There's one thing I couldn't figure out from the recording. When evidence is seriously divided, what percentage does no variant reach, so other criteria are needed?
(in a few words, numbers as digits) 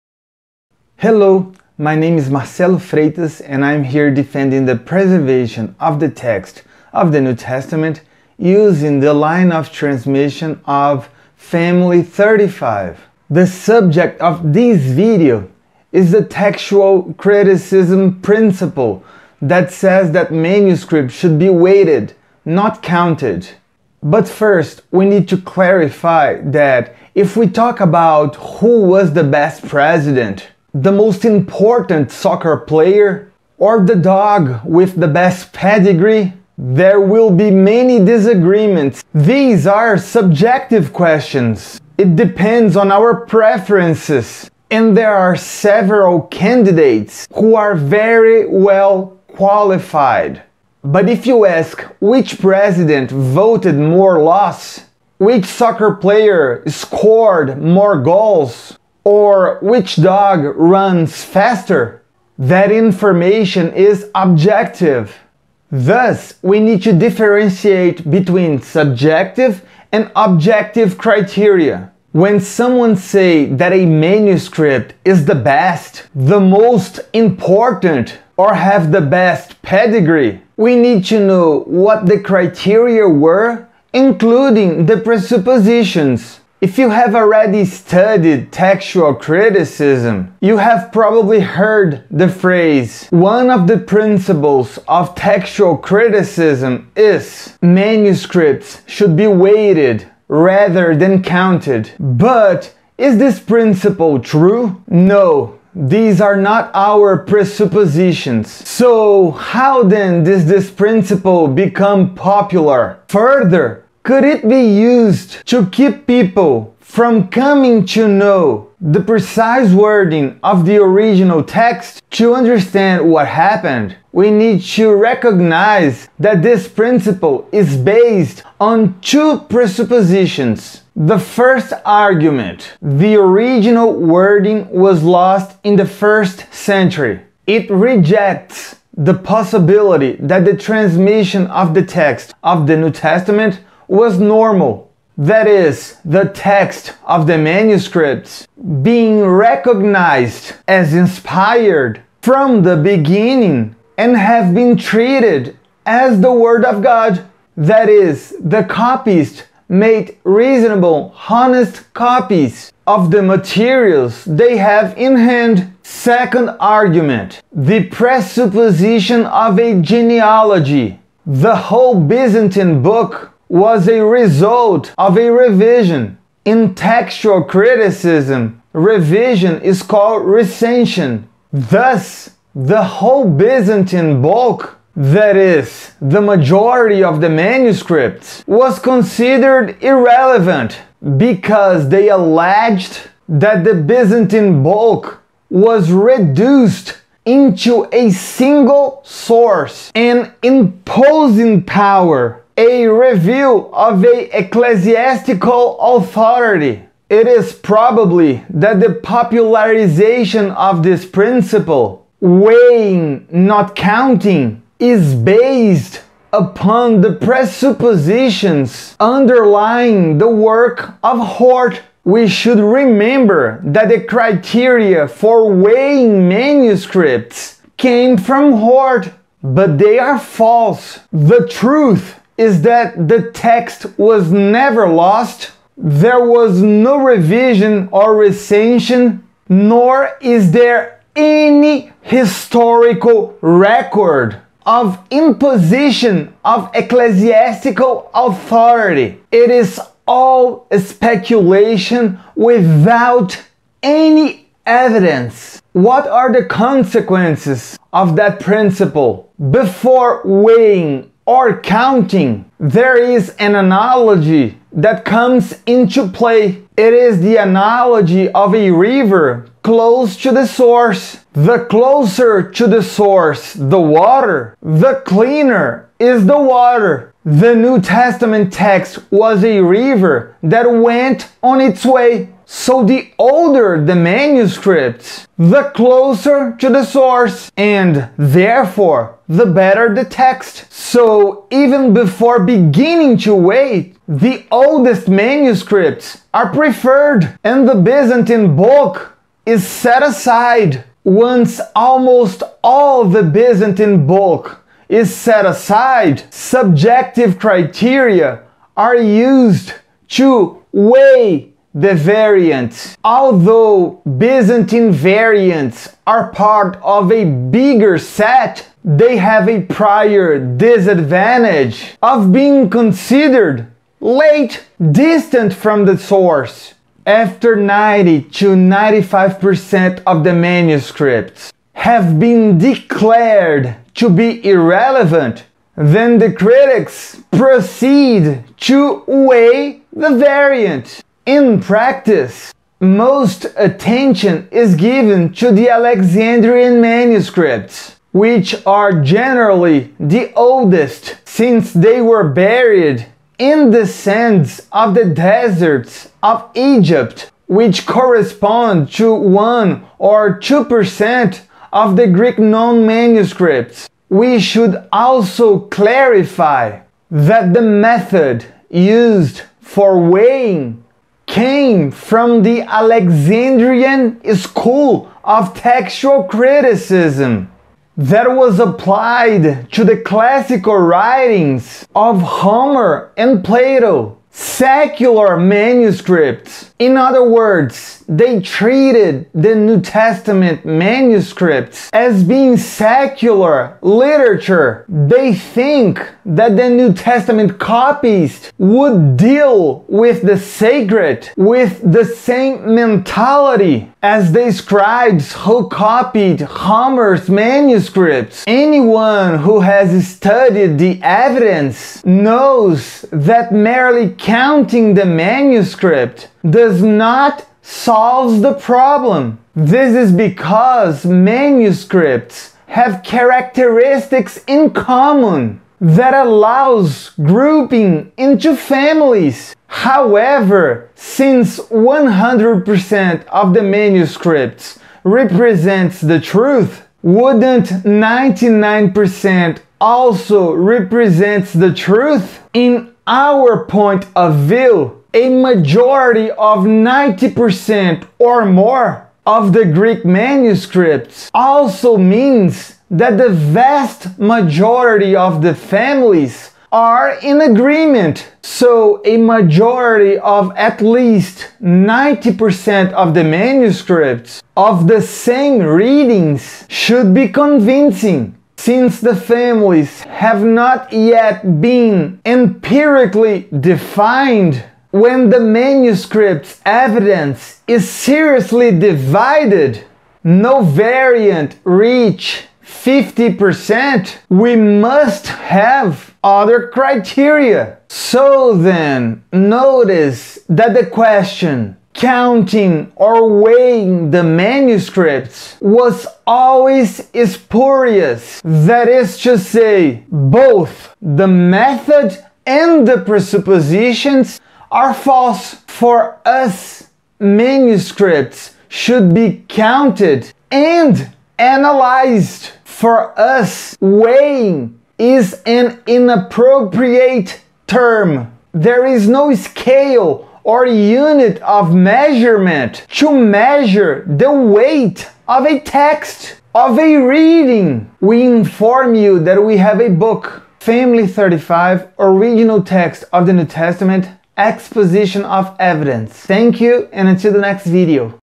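50%.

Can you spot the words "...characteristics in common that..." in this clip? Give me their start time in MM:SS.
07:03.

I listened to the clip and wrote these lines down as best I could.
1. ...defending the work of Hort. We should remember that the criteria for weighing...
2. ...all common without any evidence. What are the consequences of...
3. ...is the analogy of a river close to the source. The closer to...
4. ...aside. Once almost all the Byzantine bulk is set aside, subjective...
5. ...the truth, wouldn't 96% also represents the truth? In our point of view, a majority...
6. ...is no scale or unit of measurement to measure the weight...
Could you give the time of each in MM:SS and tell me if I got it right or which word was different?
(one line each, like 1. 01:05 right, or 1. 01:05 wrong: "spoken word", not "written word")
1. 03:38 wrong: "underlying", not "defending"
2. 04:10 wrong: "speculation", not "common"
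3. 04:26 right
4. 05:00 right
5. 07:15 wrong: "99", not "96"
6. 08:38 right.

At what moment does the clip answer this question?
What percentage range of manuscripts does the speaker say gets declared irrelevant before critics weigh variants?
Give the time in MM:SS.
05:27.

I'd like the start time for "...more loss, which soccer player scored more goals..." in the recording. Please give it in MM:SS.
00:53.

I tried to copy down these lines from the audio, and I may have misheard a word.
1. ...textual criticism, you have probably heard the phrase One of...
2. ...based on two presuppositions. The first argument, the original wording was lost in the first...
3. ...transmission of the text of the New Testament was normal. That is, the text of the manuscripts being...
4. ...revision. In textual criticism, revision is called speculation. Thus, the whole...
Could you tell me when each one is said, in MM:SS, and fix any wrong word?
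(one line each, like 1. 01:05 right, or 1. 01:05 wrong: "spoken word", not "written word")
1. 01:28 right
2. 02:07 right
3. 02:20 right
4. 02:55 wrong: "recension", not "speculation".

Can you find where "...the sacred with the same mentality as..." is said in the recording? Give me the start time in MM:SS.
06:40.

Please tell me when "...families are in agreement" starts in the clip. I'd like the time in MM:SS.
07:35.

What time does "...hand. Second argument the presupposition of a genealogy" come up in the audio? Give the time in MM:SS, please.
02:45.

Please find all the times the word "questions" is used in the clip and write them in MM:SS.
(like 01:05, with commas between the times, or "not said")
00:40, 08:10.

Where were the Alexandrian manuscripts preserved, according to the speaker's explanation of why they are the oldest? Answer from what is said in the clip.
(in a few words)
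deserts of Egypt.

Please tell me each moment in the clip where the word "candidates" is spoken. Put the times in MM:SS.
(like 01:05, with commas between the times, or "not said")
00:46.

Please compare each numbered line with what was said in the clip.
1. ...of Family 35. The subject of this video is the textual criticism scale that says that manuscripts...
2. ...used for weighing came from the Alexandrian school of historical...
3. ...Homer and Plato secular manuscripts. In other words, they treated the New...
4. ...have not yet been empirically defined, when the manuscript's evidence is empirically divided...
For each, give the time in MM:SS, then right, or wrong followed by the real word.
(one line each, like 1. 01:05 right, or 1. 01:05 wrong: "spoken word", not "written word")
1. 00:10 wrong: "principle", not "scale"
2. 06:08 wrong: "textual", not "historical"
3. 06:22 right
4. 07:50 wrong: "seriously", not "empirically".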